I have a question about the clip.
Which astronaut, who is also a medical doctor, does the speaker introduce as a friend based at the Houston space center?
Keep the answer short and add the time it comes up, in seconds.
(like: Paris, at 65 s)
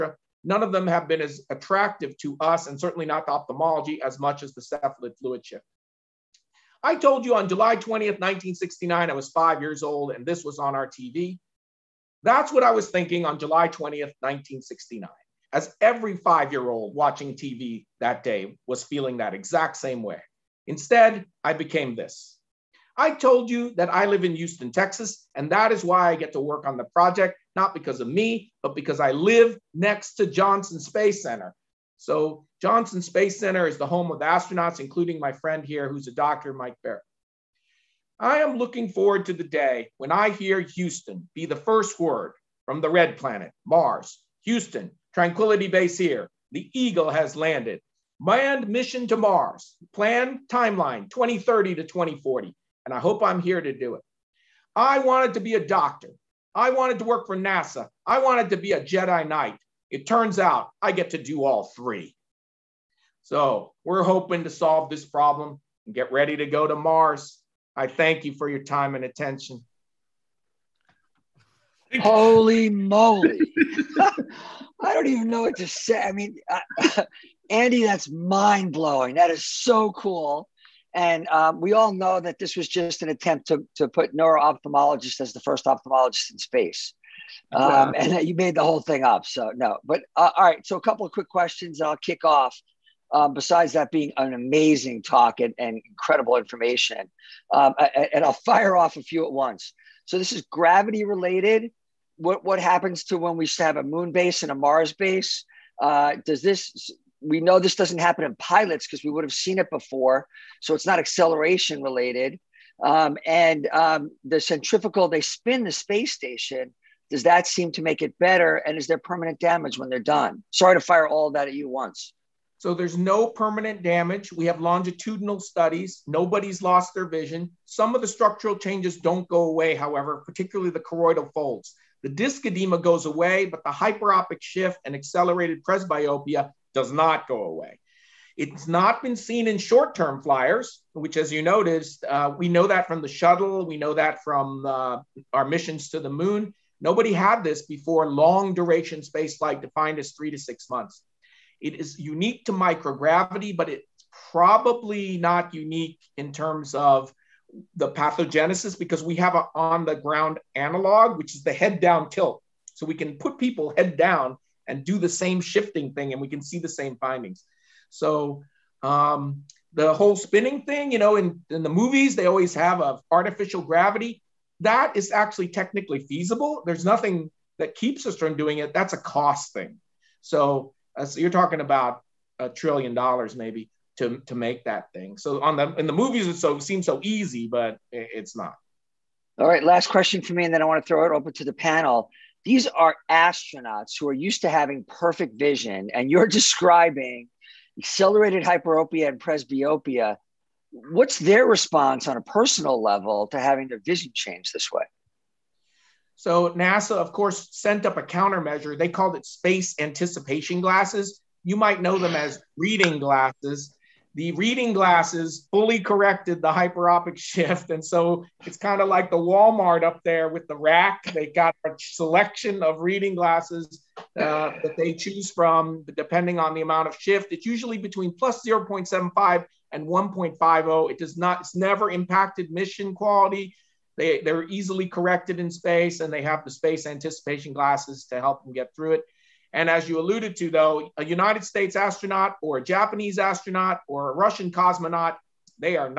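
Mike Barratt, at 36 s.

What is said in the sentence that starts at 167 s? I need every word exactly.
So um, the whole spinning thing, you know, in, in the movies, they always have a artificial gravity.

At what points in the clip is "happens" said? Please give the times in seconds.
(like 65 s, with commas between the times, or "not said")
102 s, 107 s.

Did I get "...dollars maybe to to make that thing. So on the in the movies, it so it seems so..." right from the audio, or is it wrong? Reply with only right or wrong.
right.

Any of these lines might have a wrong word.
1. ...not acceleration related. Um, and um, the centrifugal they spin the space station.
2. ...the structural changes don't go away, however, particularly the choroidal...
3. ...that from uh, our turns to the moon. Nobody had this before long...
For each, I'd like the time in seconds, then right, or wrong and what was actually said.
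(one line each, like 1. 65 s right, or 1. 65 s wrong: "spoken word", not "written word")
1. 110 s right
2. 128 s right
3. 143 s wrong: "missions", not "turns".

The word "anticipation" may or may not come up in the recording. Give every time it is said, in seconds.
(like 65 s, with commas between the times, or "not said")
209 s, 236 s.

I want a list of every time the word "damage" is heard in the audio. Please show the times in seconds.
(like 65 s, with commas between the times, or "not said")
119 s, 123 s.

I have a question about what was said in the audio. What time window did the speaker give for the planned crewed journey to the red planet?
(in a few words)
2030 to 2040.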